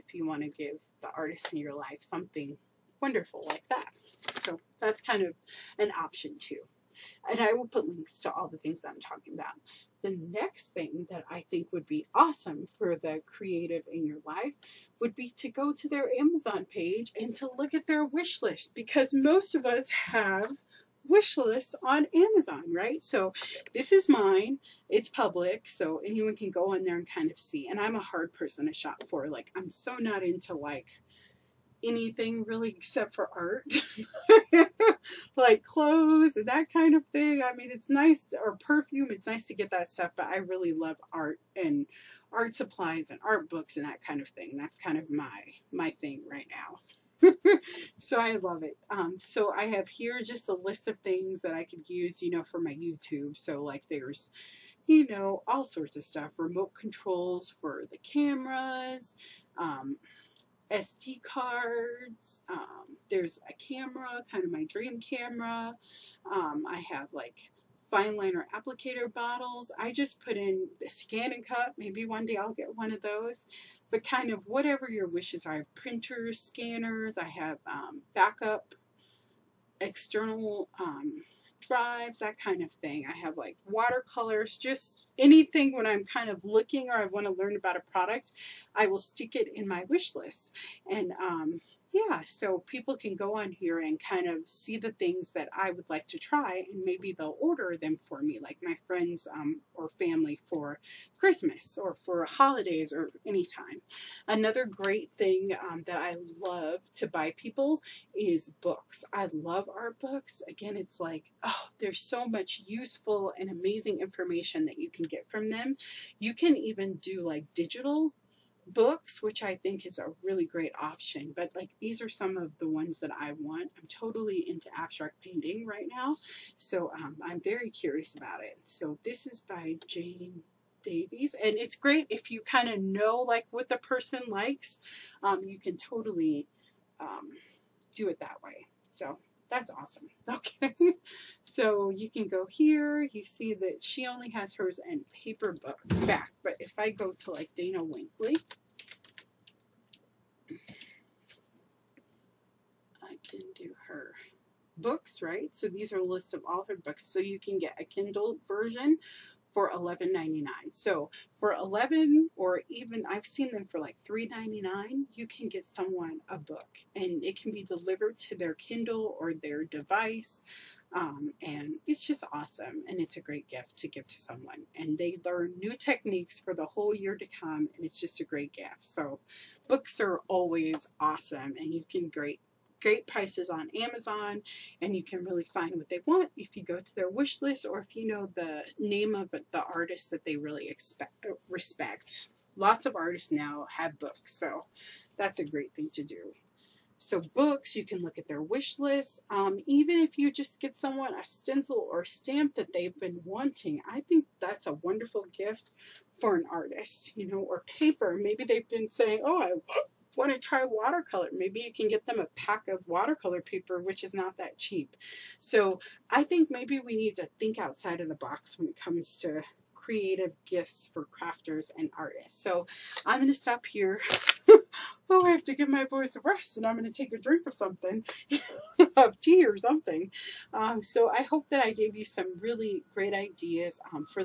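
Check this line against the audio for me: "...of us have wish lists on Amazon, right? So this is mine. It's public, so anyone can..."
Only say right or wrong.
right.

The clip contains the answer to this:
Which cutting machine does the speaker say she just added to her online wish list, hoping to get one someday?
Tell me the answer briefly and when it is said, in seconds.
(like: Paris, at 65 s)
Scan and Cut, at 70 s.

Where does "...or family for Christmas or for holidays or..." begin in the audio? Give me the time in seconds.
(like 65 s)
99 s.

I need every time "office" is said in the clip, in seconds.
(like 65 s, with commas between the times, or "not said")
not said.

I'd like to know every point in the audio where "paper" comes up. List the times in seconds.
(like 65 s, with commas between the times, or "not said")
145 s, 207 s, 213 s.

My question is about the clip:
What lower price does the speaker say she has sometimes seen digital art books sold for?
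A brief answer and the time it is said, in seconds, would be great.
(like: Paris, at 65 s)
$3.99, at 163 s.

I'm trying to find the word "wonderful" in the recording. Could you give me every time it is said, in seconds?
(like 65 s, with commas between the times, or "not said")
3 s, 204 s.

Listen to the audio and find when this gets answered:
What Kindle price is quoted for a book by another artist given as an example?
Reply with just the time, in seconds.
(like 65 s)
159 s.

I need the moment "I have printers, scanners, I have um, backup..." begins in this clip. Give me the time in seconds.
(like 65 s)
75 s.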